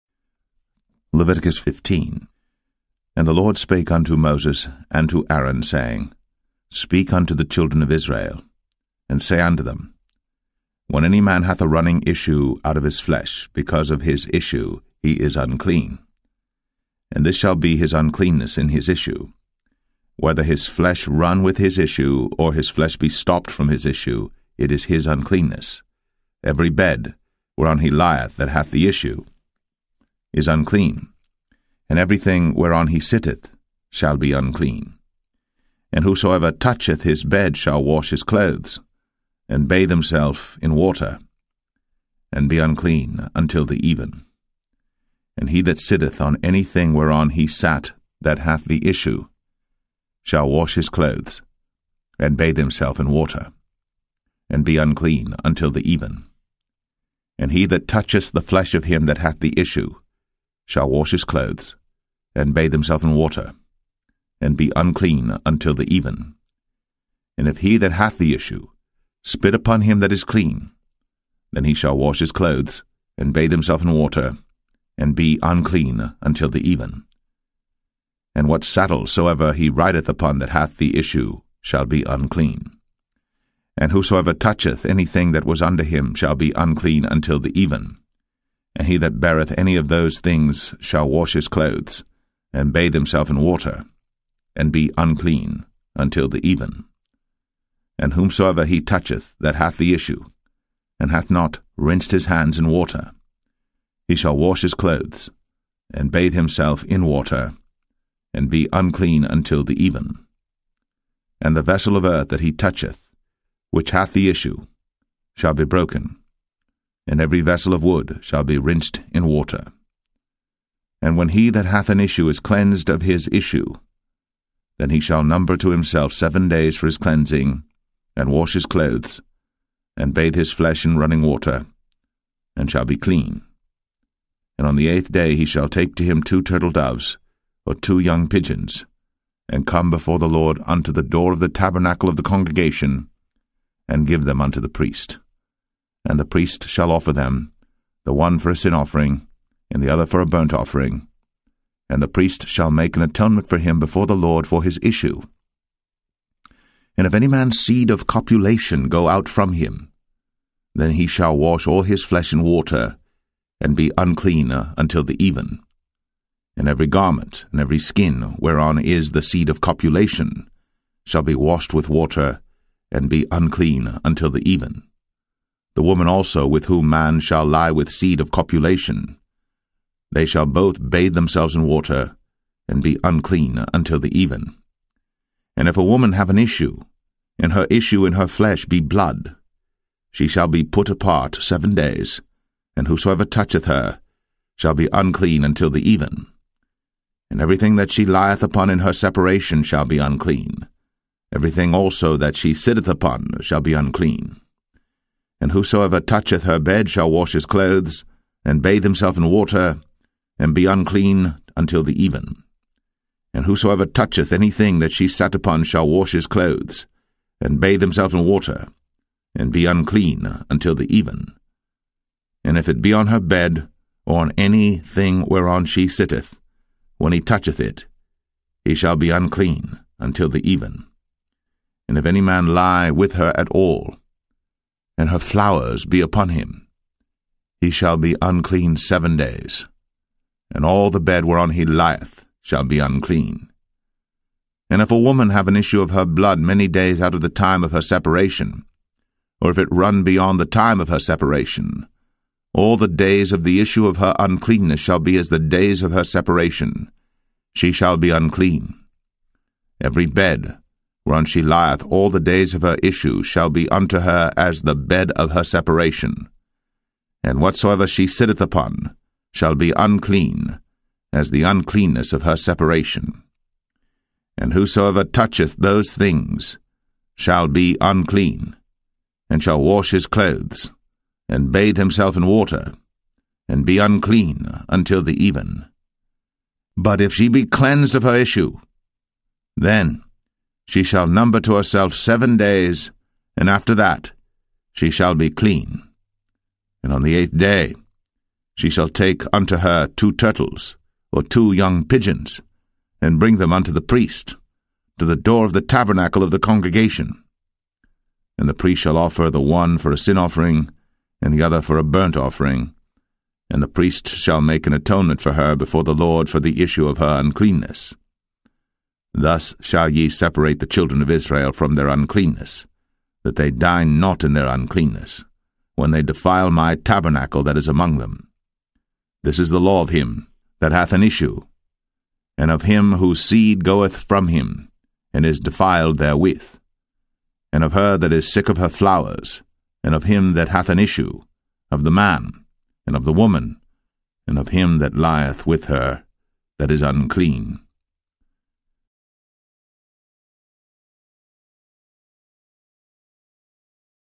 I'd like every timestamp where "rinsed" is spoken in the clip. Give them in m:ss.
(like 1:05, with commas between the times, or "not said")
1:41, 1:58.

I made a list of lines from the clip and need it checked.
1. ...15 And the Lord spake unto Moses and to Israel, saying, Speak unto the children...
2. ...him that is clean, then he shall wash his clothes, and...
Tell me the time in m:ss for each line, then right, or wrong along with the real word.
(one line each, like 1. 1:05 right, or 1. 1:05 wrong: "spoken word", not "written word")
1. 0:01 wrong: "Aaron", not "Israel"
2. 1:09 right.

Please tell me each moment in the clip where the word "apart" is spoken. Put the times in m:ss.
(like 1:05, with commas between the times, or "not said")
3:10.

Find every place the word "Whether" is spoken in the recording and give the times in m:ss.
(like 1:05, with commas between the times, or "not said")
0:20.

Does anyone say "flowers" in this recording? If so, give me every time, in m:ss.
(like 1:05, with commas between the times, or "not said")
3:55, 5:38.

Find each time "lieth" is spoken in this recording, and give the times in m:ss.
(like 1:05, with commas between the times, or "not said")
0:27, 3:18, 4:01, 4:21, 5:44.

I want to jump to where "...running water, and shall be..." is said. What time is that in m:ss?
2:10.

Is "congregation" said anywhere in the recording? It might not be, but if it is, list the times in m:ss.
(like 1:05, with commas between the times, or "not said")
2:22, 5:06.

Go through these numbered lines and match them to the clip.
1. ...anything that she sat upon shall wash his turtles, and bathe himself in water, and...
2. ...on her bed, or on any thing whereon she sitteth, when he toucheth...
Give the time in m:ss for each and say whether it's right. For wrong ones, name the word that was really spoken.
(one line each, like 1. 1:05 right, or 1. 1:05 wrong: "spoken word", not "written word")
1. 3:34 wrong: "clothes", not "turtles"
2. 3:42 right.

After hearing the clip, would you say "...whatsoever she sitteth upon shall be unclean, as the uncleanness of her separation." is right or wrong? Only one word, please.
right.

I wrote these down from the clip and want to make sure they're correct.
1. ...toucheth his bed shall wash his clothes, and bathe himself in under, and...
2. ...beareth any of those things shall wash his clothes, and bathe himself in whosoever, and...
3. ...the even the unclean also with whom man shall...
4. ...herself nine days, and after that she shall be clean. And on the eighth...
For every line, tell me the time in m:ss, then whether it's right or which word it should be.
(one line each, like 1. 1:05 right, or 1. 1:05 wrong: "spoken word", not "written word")
1. 0:36 wrong: "water", not "under"
2. 1:29 wrong: "water", not "whosoever"
3. 2:54 wrong: "woman", not "unclean"
4. 4:51 wrong: "seven", not "nine".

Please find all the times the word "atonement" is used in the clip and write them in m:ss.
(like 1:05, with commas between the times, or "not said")
2:33, 5:14.